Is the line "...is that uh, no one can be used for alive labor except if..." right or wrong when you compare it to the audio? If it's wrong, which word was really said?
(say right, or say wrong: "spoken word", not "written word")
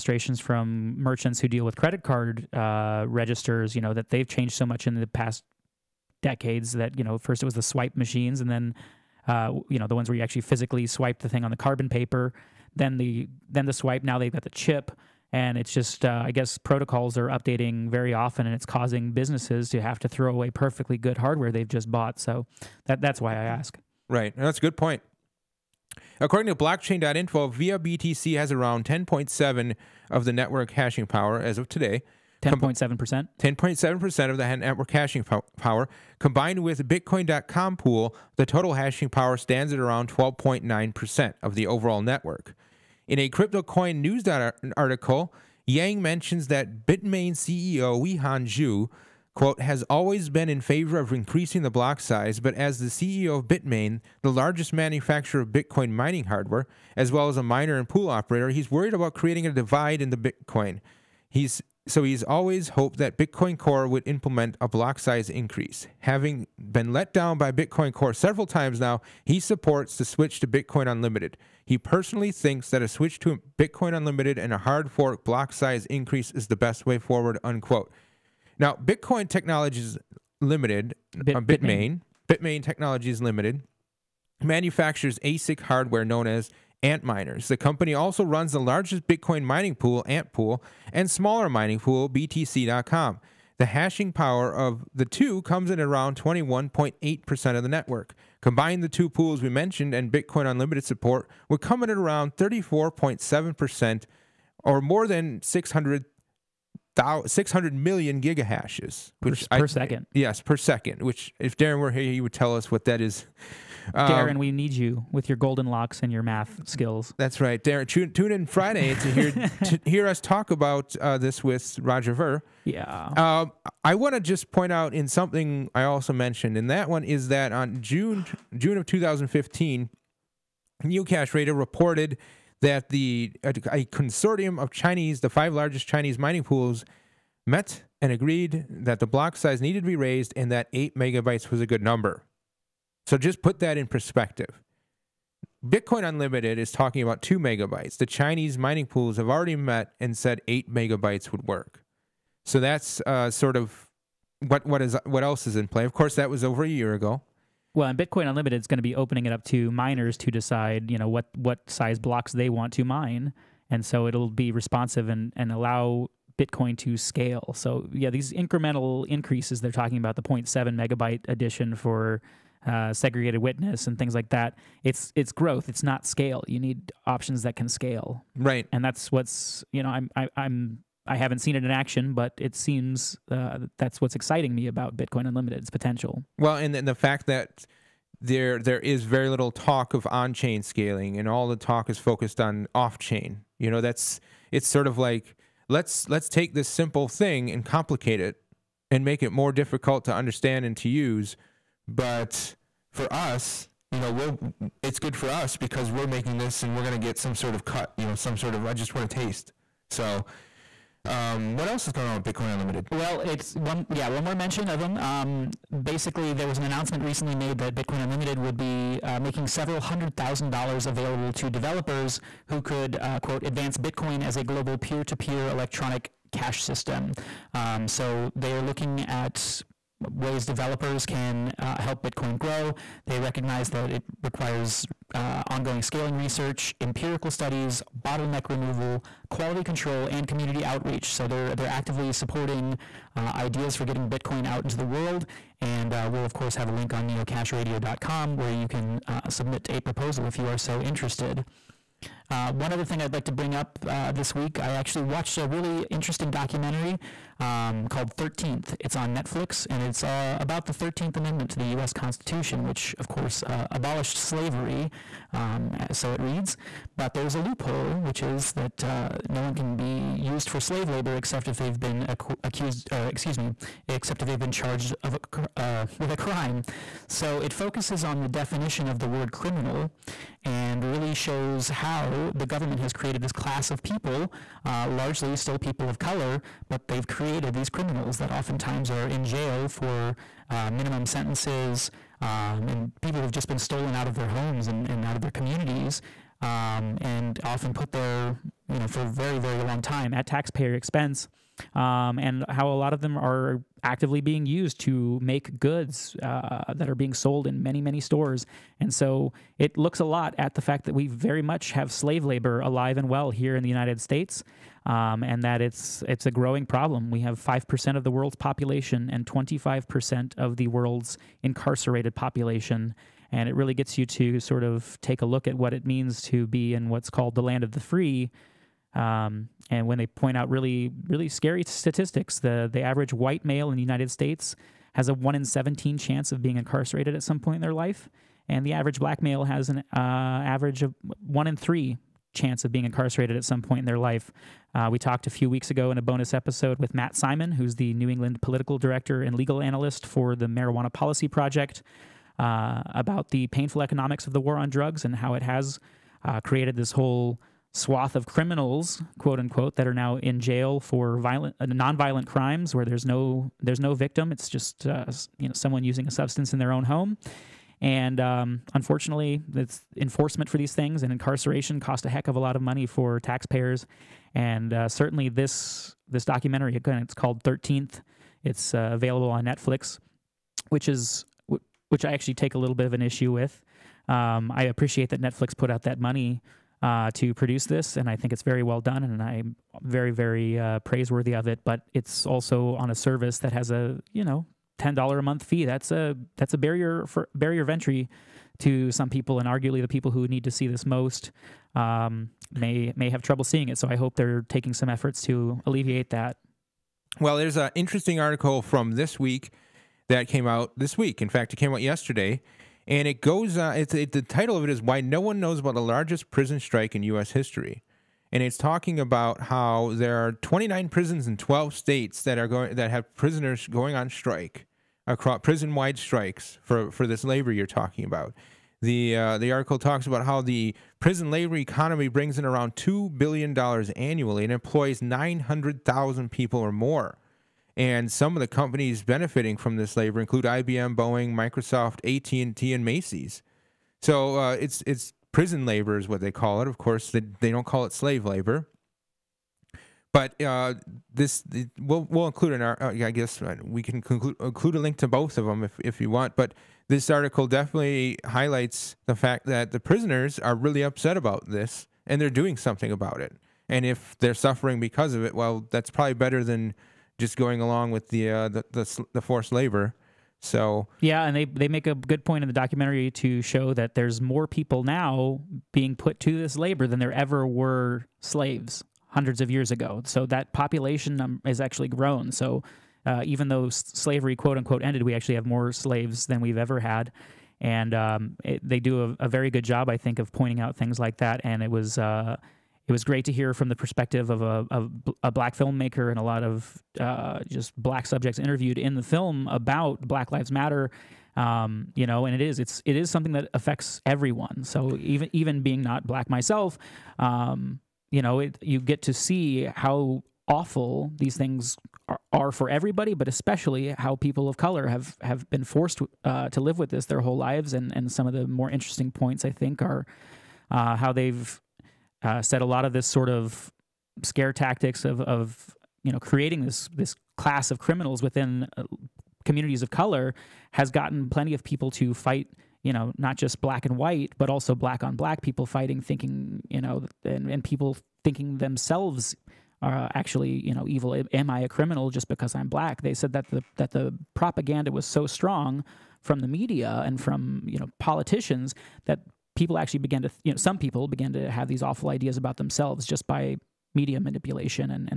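wrong: "slave", not "alive".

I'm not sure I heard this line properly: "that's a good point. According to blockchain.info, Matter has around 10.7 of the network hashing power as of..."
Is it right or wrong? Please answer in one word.
wrong.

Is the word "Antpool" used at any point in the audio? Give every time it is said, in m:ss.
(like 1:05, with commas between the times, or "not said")
1:30.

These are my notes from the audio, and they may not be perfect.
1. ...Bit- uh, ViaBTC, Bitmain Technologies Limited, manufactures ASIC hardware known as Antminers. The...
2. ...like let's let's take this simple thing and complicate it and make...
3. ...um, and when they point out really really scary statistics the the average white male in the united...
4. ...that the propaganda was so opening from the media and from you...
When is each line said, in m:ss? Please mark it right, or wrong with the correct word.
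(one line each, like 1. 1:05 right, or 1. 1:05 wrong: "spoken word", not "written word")
1. 1:21 wrong: "Bitmain", not "ViaBTC"
2. 3:14 right
3. 5:28 right
4. 9:03 wrong: "strong", not "opening".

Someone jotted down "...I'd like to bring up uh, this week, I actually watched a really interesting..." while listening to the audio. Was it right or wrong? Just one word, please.
right.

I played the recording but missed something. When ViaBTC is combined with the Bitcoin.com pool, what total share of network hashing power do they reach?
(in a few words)
12.9%.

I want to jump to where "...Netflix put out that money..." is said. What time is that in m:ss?
6:25.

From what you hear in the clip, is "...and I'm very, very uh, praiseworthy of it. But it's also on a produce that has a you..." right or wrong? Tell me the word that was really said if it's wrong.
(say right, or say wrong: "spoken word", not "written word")
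wrong: "service", not "produce".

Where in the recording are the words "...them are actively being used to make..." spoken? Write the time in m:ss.
5:03.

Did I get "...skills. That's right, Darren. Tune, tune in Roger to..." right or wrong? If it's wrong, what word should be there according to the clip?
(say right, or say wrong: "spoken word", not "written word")
wrong: "Friday", not "Roger".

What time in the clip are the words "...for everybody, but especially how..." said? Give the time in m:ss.
8:32.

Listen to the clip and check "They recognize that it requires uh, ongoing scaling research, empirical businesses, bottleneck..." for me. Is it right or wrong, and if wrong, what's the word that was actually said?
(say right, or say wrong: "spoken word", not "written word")
wrong: "studies", not "businesses".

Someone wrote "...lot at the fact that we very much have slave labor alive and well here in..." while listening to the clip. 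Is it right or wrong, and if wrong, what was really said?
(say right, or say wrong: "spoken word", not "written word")
right.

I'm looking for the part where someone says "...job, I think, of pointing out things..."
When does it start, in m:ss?
8:09.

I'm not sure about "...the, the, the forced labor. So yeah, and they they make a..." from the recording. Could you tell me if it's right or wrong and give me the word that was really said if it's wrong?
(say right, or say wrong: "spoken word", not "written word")
right.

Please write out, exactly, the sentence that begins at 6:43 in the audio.
So I hope they're taking some efforts to alleviate that.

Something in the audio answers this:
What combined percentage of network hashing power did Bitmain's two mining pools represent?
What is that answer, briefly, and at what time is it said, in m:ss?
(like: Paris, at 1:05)
21.8%, at 1:36.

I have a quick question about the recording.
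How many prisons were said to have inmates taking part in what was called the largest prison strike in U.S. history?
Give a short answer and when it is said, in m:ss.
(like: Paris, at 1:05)
29, at 7:00.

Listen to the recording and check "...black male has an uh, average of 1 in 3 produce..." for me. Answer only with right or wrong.
wrong.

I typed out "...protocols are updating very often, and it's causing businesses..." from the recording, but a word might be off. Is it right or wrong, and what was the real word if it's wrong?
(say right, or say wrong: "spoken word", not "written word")
right.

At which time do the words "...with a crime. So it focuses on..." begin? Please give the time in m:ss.
4:35.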